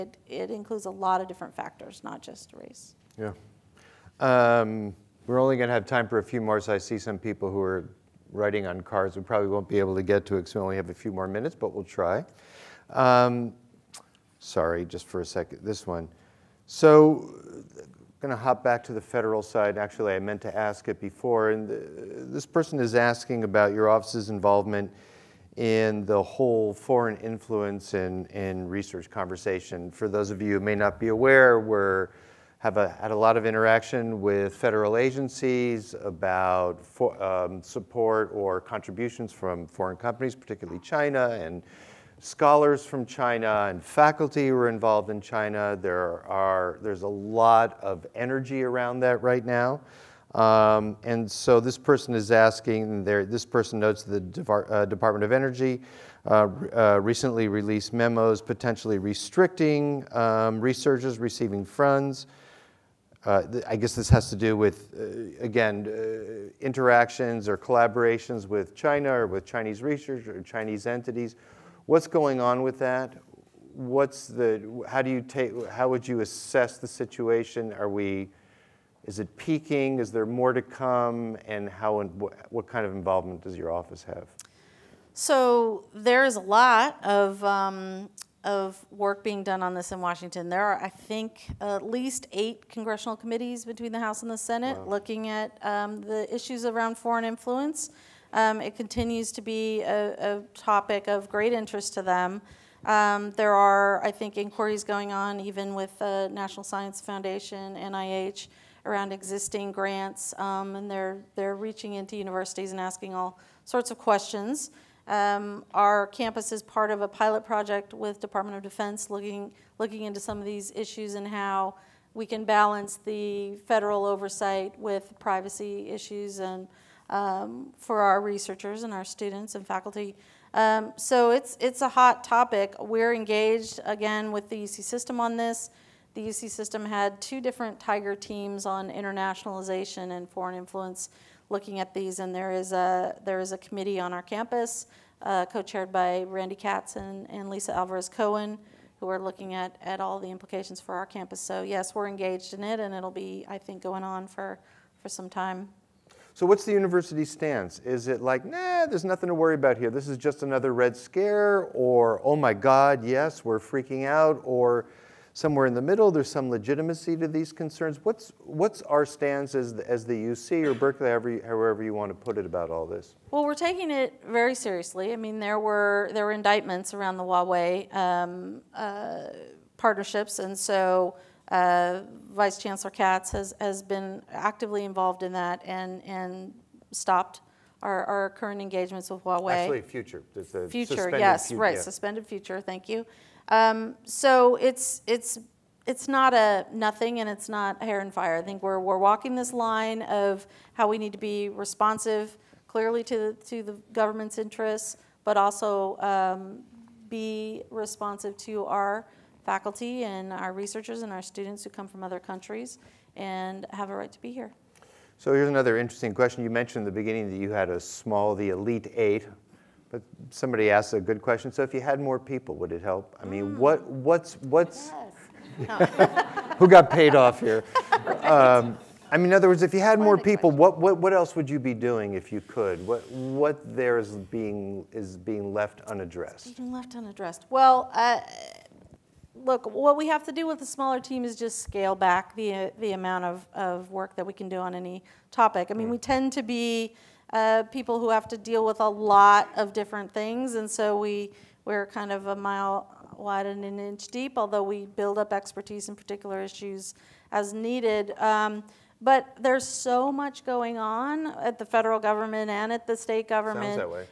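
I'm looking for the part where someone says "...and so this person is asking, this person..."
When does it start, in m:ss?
0:51.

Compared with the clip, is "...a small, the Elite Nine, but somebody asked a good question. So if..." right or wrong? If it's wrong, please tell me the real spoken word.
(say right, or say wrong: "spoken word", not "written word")
wrong: "Eight", not "Nine".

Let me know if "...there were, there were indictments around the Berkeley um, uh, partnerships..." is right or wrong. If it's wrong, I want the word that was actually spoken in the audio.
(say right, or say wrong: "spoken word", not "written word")
wrong: "Huawei", not "Berkeley".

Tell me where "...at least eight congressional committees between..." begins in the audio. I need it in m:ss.
1:31.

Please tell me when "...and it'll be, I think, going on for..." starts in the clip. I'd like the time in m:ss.
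2:32.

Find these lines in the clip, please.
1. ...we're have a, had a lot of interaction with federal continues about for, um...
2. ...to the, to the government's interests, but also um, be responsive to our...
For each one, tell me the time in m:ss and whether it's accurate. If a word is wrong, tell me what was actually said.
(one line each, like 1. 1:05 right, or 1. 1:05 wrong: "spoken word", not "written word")
1. 0:31 wrong: "agencies", not "continues"
2. 3:23 right.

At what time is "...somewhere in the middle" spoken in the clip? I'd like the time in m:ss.
2:45.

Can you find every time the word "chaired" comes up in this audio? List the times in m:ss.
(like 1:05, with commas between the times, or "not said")
2:25.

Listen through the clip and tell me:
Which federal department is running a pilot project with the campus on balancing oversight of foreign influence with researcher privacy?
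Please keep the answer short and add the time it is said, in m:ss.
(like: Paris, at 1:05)
Department of Defense, at 1:58.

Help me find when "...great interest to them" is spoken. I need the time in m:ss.
1:41.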